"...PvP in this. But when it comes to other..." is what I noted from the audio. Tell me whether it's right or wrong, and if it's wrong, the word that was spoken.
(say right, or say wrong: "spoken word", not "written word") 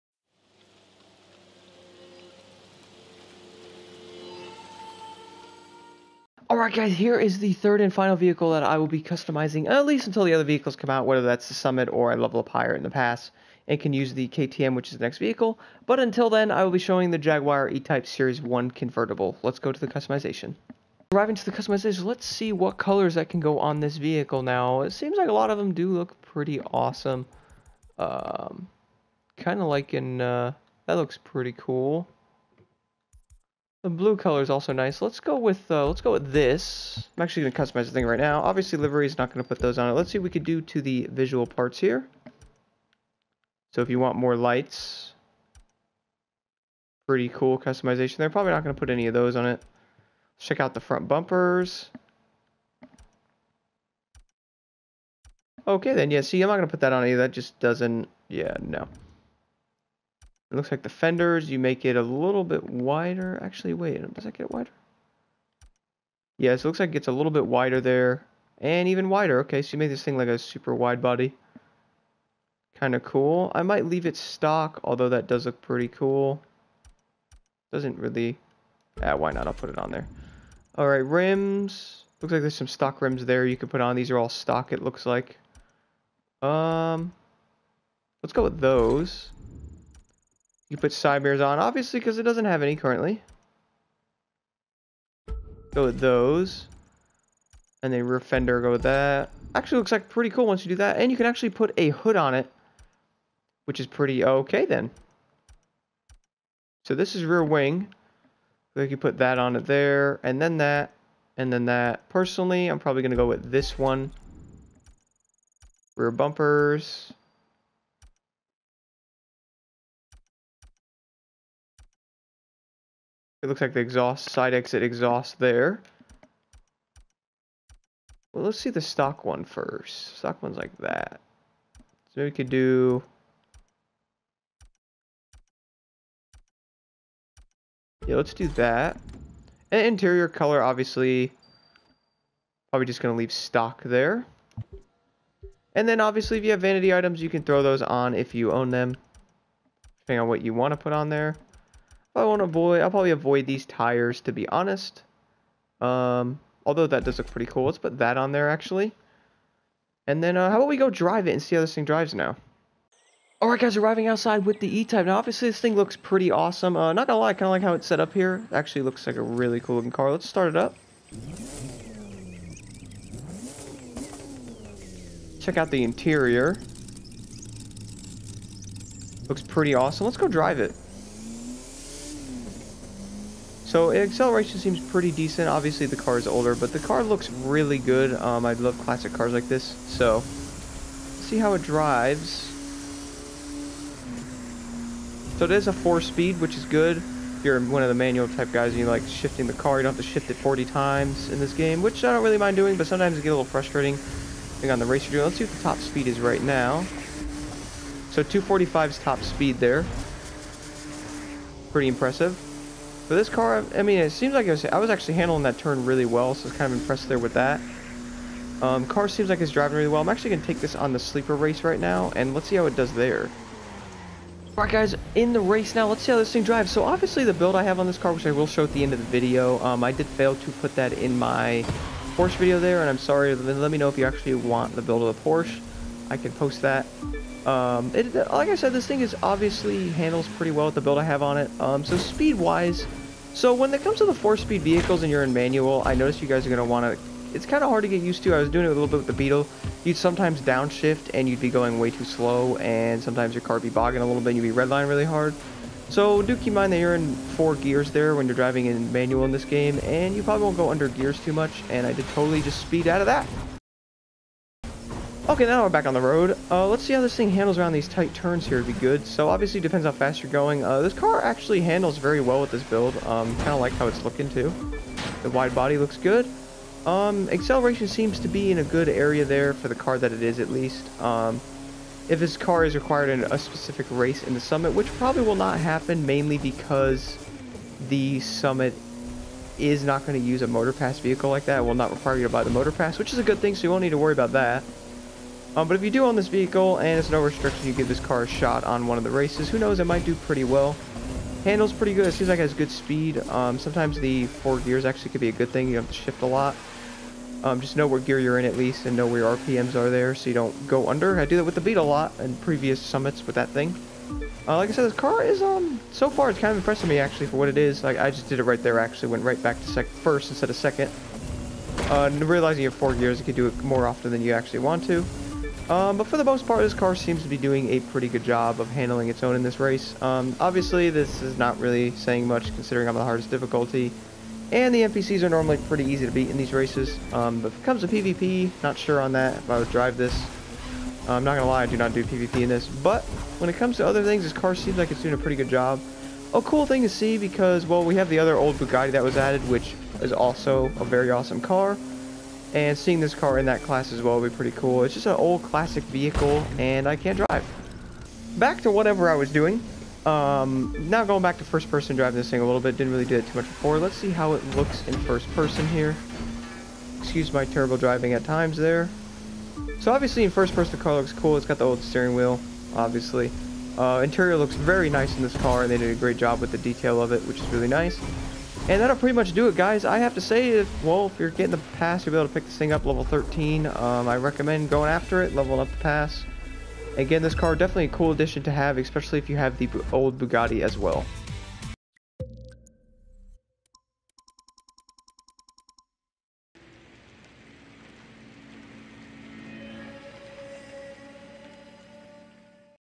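right.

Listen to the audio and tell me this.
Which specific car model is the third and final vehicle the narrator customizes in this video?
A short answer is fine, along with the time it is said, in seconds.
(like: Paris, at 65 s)
Jaguar E-Type Series 1 convertible, at 17 s.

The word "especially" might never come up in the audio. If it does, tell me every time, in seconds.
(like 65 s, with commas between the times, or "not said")
388 s.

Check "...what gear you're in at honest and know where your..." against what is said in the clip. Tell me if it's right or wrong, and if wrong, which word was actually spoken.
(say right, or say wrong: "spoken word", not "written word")
wrong: "least", not "honest".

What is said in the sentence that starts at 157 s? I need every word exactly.
Let's put that on there actually.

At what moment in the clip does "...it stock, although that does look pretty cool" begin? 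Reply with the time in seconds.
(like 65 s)
74 s.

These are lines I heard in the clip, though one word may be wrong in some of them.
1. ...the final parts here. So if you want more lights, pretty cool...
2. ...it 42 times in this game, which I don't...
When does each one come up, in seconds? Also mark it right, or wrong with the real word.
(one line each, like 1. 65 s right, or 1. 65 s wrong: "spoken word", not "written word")
1. 40 s wrong: "visual", not "final"
2. 200 s wrong: "40", not "42".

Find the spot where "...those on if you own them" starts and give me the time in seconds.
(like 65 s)
147 s.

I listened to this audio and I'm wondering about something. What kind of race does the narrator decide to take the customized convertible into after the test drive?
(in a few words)
sleeper race.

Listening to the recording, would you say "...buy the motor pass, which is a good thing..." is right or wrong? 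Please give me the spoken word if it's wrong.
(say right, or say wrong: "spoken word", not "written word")
right.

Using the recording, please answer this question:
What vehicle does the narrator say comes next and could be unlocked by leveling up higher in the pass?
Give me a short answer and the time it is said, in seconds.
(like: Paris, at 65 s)
KTM, at 14 s.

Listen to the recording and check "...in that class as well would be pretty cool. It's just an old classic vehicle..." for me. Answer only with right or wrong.
right.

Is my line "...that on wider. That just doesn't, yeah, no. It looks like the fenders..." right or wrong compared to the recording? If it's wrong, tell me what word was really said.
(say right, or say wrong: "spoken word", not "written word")
wrong: "either", not "wider".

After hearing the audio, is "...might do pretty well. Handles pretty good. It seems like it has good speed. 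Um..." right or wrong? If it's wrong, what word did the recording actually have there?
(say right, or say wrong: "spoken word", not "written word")
right.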